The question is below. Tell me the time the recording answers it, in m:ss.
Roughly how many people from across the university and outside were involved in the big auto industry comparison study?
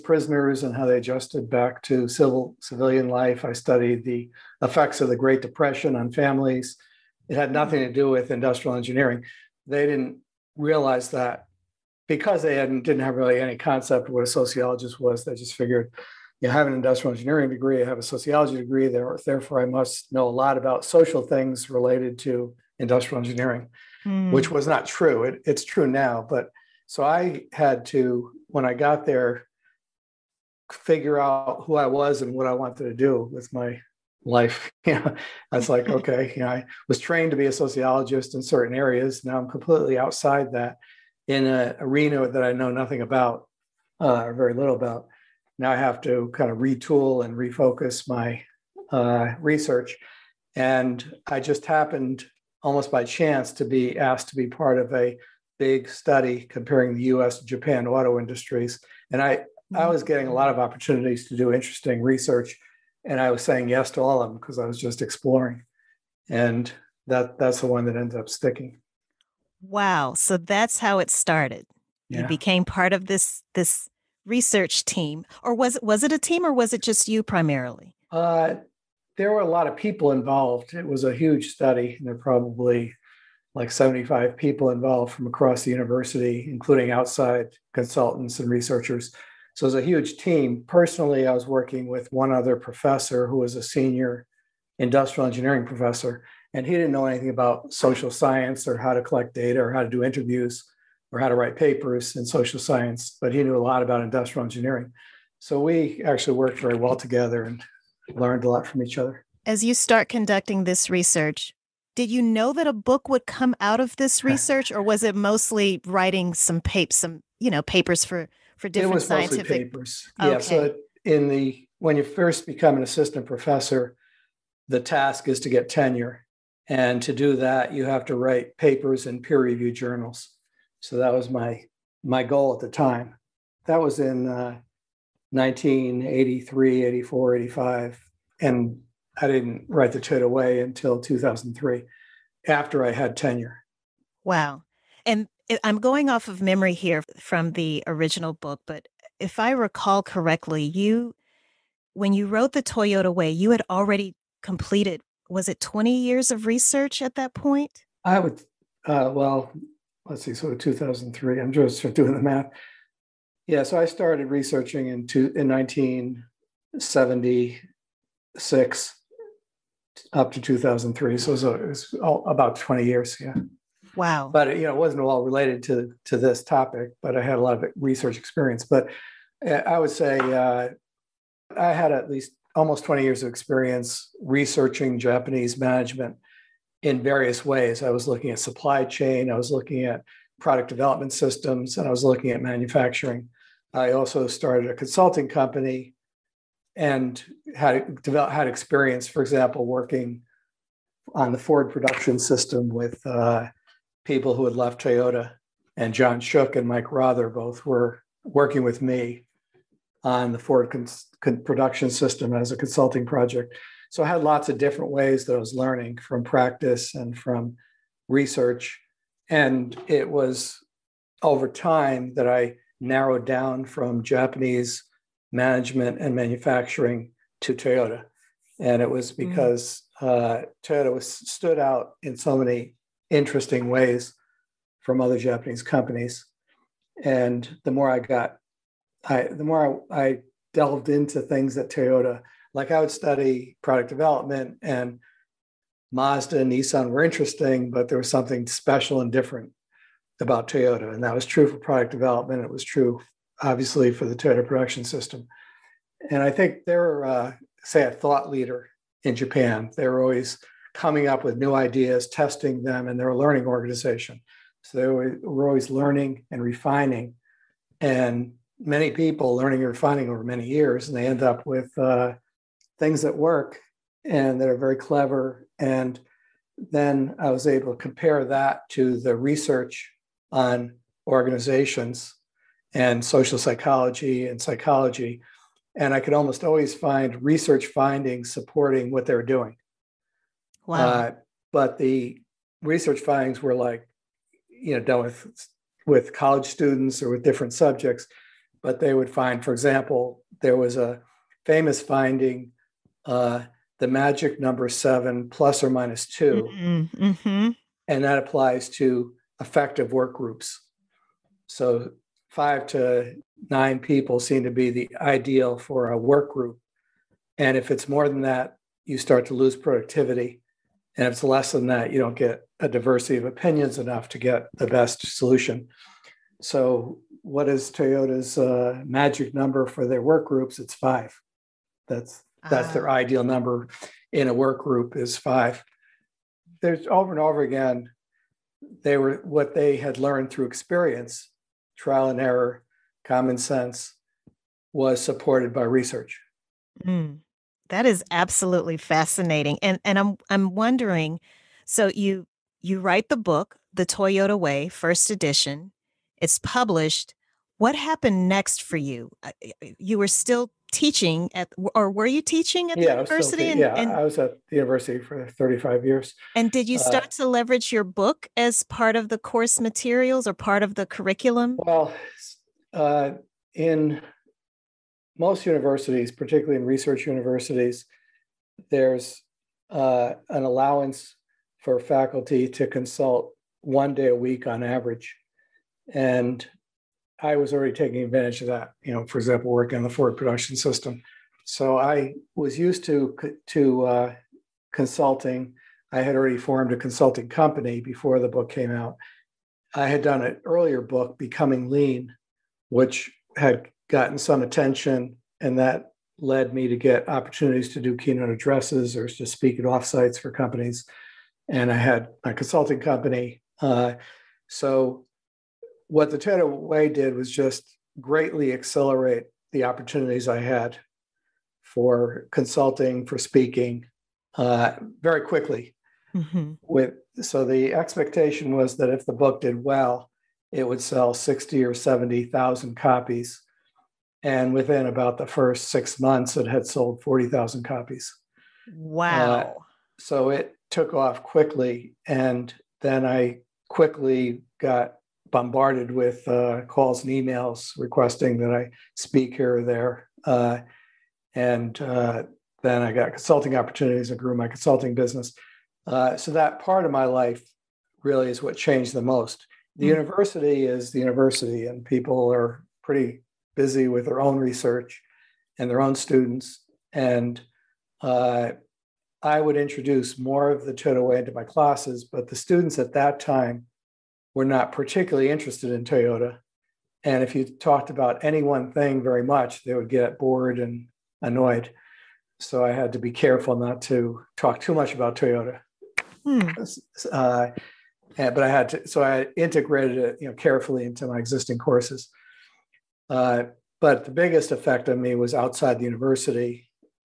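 1:23.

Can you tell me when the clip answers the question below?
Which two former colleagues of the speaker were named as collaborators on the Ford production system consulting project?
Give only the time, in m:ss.
3:25.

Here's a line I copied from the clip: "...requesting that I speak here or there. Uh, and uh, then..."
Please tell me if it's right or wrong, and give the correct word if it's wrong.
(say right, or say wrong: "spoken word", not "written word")
right.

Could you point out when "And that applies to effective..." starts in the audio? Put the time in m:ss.
5:07.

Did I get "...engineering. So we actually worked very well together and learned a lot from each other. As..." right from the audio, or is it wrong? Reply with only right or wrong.
right.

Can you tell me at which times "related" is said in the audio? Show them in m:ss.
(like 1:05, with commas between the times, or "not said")
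0:21, 2:55.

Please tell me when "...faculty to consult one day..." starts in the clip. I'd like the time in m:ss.
6:21.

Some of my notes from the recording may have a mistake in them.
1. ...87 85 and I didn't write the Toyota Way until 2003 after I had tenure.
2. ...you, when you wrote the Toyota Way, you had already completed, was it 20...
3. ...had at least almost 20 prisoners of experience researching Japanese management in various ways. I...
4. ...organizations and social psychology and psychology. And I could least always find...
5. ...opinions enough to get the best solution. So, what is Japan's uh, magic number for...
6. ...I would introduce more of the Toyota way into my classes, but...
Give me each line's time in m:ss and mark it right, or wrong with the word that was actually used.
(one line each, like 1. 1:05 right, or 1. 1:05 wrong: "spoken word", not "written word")
1. 2:16 wrong: "84", not "87"
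2. 2:30 right
3. 3:01 wrong: "years", not "prisoners"
4. 4:41 wrong: "almost", not "least"
5. 5:23 wrong: "Toyota", not "Japan"
6. 7:49 right.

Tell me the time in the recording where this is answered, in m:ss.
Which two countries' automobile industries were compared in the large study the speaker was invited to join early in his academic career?
0:57.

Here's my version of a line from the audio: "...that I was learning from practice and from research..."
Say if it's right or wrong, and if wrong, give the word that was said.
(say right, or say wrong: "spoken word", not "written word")
right.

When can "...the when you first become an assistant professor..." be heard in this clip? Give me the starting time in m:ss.
2:01.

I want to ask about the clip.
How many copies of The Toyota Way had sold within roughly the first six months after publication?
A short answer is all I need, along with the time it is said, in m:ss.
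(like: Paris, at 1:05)
40,000, at 7:17.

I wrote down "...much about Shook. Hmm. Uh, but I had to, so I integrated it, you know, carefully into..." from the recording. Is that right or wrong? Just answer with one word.
wrong.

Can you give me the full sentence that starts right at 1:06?
And that that's the one that ends up sticking.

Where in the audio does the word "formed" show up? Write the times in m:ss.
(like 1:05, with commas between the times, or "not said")
6:36.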